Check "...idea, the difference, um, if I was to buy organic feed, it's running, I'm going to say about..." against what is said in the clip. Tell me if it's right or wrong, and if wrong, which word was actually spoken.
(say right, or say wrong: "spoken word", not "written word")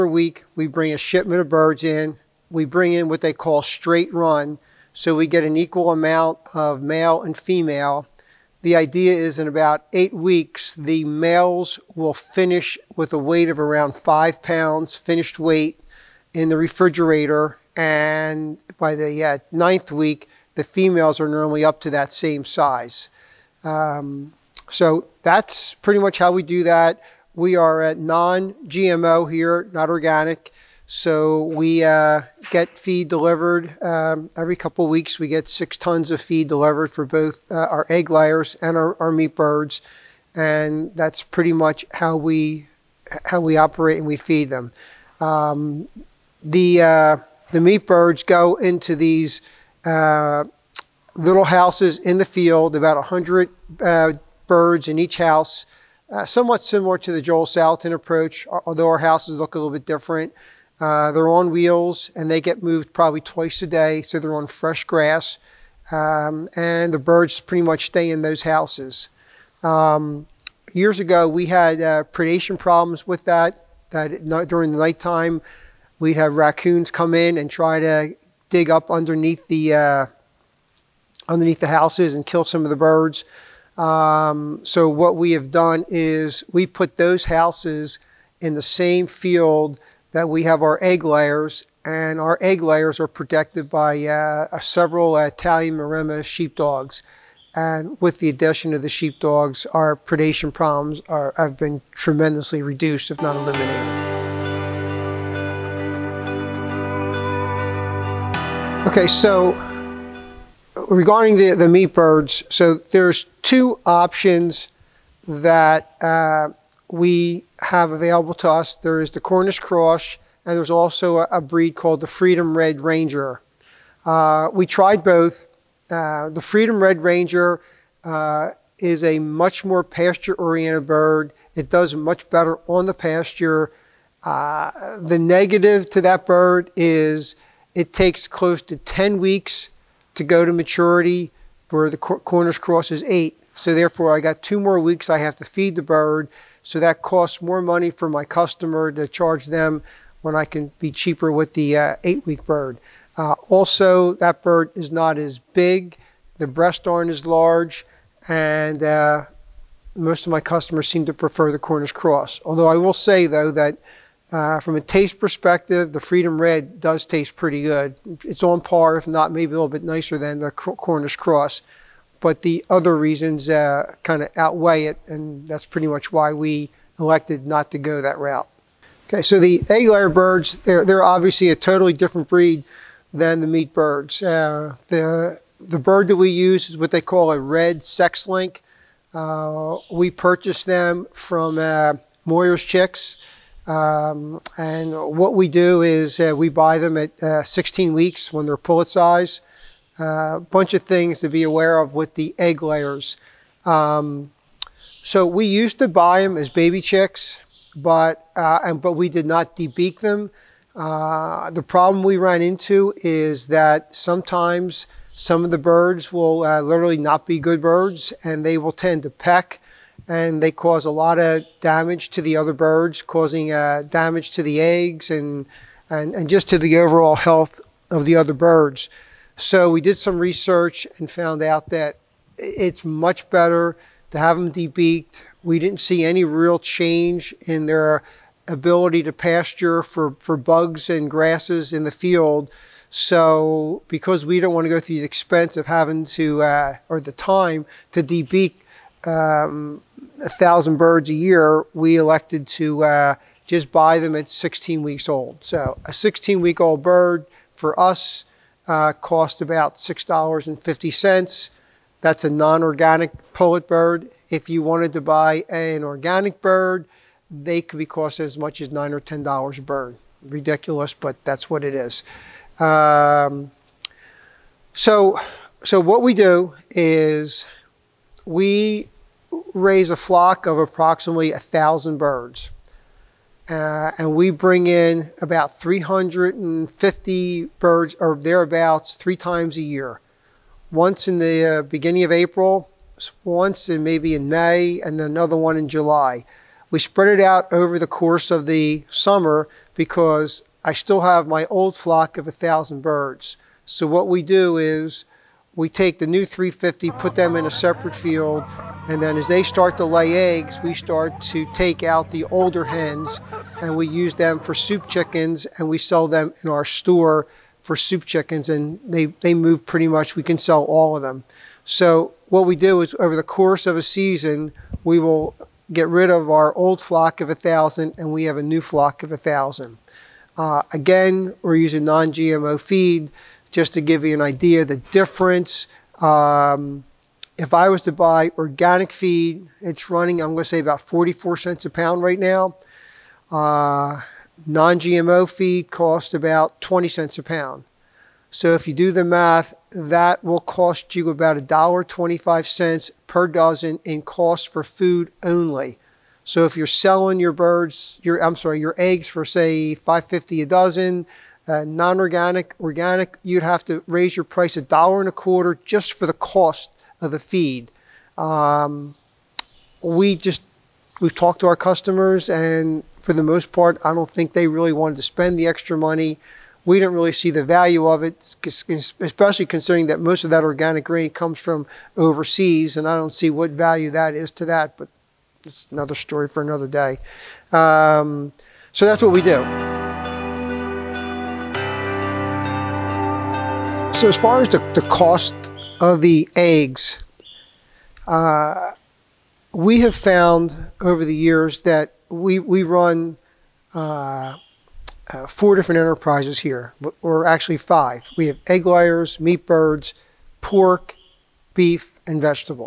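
right.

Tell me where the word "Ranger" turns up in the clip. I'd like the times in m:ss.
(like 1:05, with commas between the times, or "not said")
2:02, 2:07.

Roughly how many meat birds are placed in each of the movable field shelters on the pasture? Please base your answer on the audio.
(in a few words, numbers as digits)
100.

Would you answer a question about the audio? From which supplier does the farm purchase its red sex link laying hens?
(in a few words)
Moyer's Chicks.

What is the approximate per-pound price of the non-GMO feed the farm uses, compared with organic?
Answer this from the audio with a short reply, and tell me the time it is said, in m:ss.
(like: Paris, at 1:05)
20 cents, at 5:46.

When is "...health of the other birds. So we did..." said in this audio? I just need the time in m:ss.
3:47.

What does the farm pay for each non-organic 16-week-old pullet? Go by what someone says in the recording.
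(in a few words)
$6.50.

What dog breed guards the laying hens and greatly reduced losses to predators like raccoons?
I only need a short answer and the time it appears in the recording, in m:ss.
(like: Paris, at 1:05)
Italian Maremma sheepdogs, at 1:35.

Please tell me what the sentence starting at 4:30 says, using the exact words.
Ridiculous, but that's what it is.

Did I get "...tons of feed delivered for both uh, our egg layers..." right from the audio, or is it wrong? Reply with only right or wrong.
right.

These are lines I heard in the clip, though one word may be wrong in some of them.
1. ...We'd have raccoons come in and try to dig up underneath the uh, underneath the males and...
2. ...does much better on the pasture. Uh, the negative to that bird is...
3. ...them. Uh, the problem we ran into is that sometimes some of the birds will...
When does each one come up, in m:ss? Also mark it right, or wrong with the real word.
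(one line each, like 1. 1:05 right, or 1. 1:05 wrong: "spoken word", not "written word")
1. 1:15 wrong: "houses", not "males"
2. 2:11 right
3. 3:29 right.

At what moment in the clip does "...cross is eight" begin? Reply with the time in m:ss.
2:22.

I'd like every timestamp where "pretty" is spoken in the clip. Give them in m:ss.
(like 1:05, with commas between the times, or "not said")
0:25, 0:41, 1:07, 2:47, 2:55, 5:19.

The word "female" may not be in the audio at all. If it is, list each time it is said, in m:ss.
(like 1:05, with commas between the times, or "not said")
0:07, 0:20.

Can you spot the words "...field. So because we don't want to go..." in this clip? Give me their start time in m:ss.
4:01.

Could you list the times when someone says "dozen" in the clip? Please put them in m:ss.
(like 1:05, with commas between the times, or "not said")
5:53, 6:00.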